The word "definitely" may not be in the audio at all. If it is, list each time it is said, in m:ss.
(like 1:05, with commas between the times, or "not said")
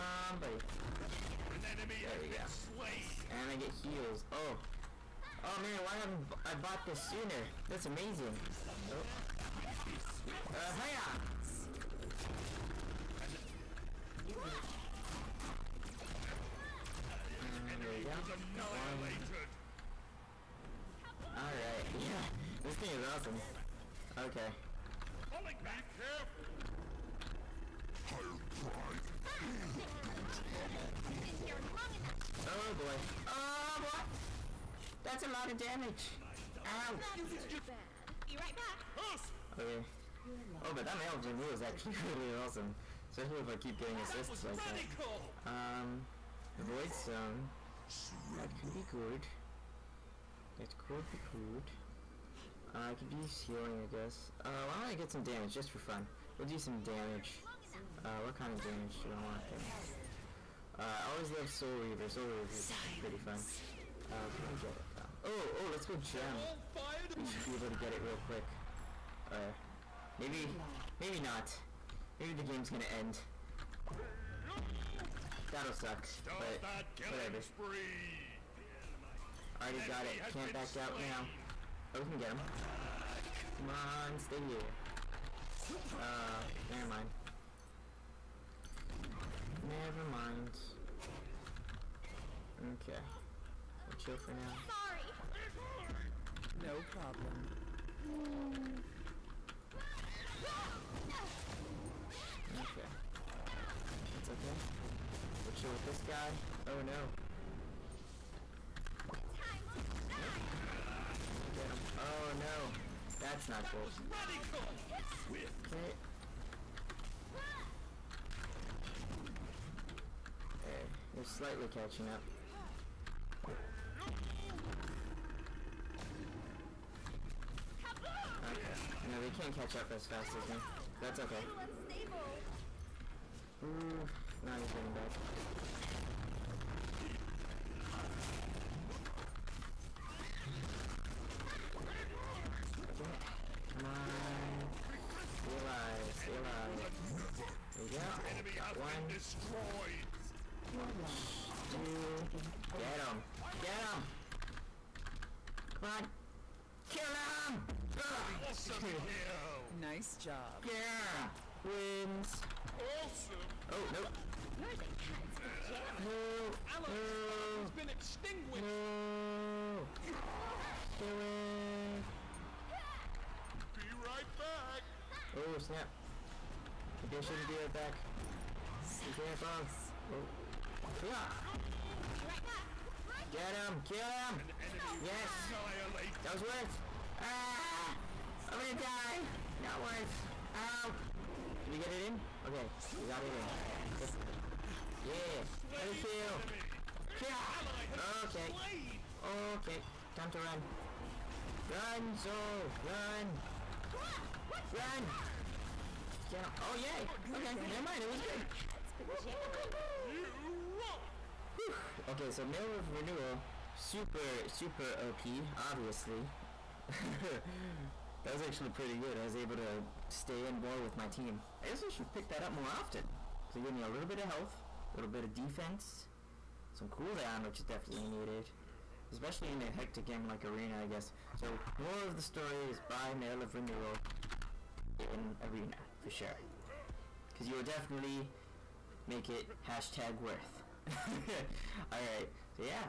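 3:47, 3:57.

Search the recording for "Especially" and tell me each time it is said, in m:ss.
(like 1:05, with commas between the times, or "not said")
0:43, 3:49.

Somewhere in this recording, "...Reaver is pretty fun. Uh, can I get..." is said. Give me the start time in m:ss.
1:02.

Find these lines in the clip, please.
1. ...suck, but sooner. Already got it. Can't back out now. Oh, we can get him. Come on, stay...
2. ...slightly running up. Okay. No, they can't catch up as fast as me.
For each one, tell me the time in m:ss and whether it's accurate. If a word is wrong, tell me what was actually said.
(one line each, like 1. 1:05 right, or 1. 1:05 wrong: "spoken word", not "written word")
1. 1:15 wrong: "whatever", not "sooner"
2. 2:01 wrong: "catching", not "running".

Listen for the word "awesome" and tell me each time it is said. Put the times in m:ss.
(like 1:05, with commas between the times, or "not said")
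0:23, 0:42.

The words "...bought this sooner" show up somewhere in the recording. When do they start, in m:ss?
0:06.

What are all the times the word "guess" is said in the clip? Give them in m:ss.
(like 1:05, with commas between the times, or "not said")
0:53, 3:41, 3:50.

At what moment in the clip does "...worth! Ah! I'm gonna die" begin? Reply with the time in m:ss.
3:06.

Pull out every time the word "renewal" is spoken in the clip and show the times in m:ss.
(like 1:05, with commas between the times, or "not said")
0:41, 3:32, 3:53.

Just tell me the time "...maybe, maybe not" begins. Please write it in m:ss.
1:10.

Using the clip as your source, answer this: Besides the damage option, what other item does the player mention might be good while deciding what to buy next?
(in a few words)
Void Stone.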